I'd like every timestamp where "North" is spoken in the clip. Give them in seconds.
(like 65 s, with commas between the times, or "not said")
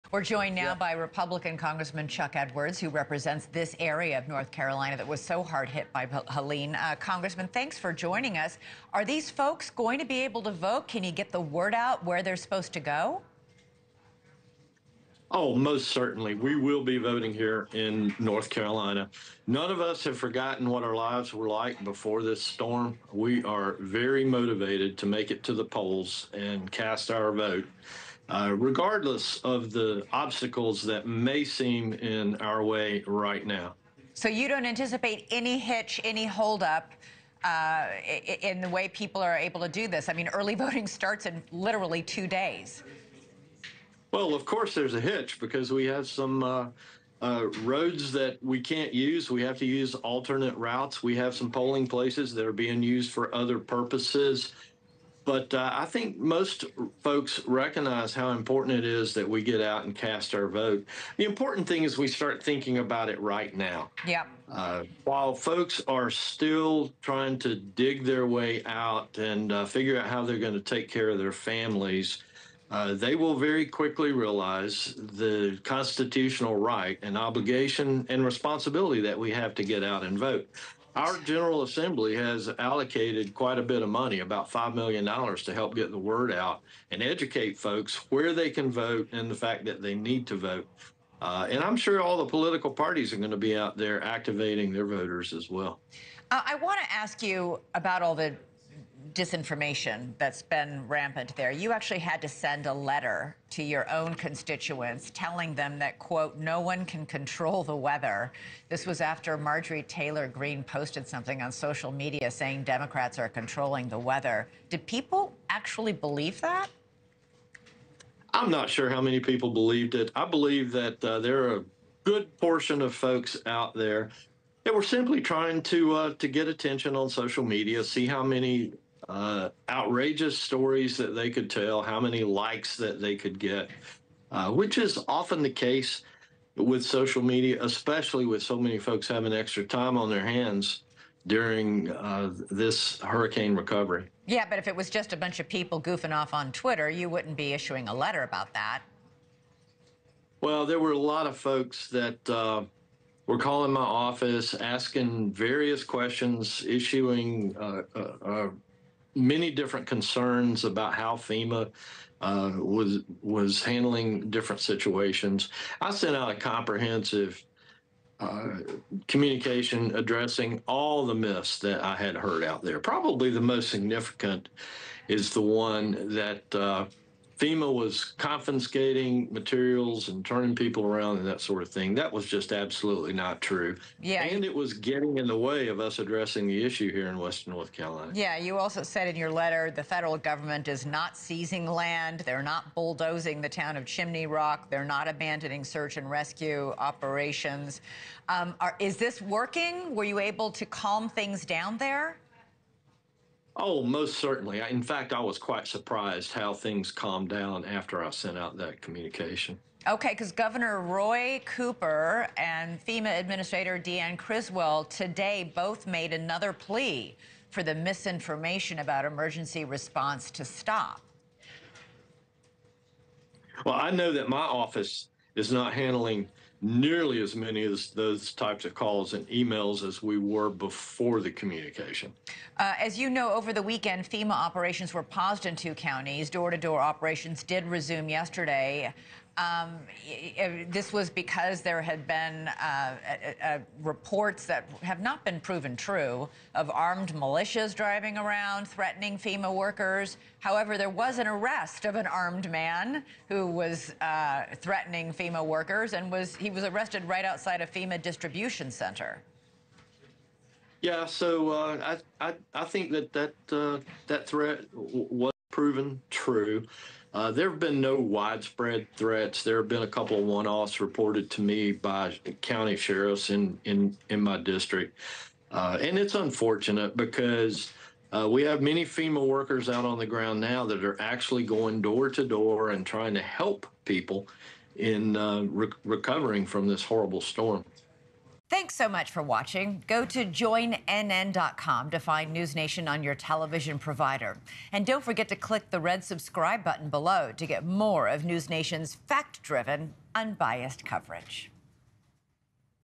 4 s, 18 s, 187 s.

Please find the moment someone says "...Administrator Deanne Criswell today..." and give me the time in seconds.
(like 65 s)
213 s.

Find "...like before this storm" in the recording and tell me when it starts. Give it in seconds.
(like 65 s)
21 s.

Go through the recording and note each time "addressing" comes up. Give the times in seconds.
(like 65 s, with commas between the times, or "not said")
169 s, 185 s.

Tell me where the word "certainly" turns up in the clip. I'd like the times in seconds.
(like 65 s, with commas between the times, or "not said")
15 s, 204 s.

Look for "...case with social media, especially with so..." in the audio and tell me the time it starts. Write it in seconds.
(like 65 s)
135 s.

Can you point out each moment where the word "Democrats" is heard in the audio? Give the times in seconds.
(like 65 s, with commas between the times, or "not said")
112 s.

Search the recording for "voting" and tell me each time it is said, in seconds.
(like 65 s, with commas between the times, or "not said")
16 s, 40 s.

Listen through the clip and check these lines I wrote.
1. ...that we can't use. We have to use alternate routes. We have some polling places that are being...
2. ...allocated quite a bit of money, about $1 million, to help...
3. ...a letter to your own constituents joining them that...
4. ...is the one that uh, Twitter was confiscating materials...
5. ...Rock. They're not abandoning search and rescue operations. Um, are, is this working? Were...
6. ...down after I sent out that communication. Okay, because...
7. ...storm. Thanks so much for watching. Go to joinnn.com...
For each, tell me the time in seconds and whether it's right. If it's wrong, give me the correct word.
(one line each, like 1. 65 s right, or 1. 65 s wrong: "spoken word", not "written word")
1. 48 s right
2. 82 s wrong: "5", not "1"
3. 102 s wrong: "telling", not "joining"
4. 175 s wrong: "FEMA", not "Twitter"
5. 194 s right
6. 207 s right
7. 287 s right.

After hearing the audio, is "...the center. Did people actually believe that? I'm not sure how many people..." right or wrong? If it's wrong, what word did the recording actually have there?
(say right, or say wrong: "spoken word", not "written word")
wrong: "weather", not "center".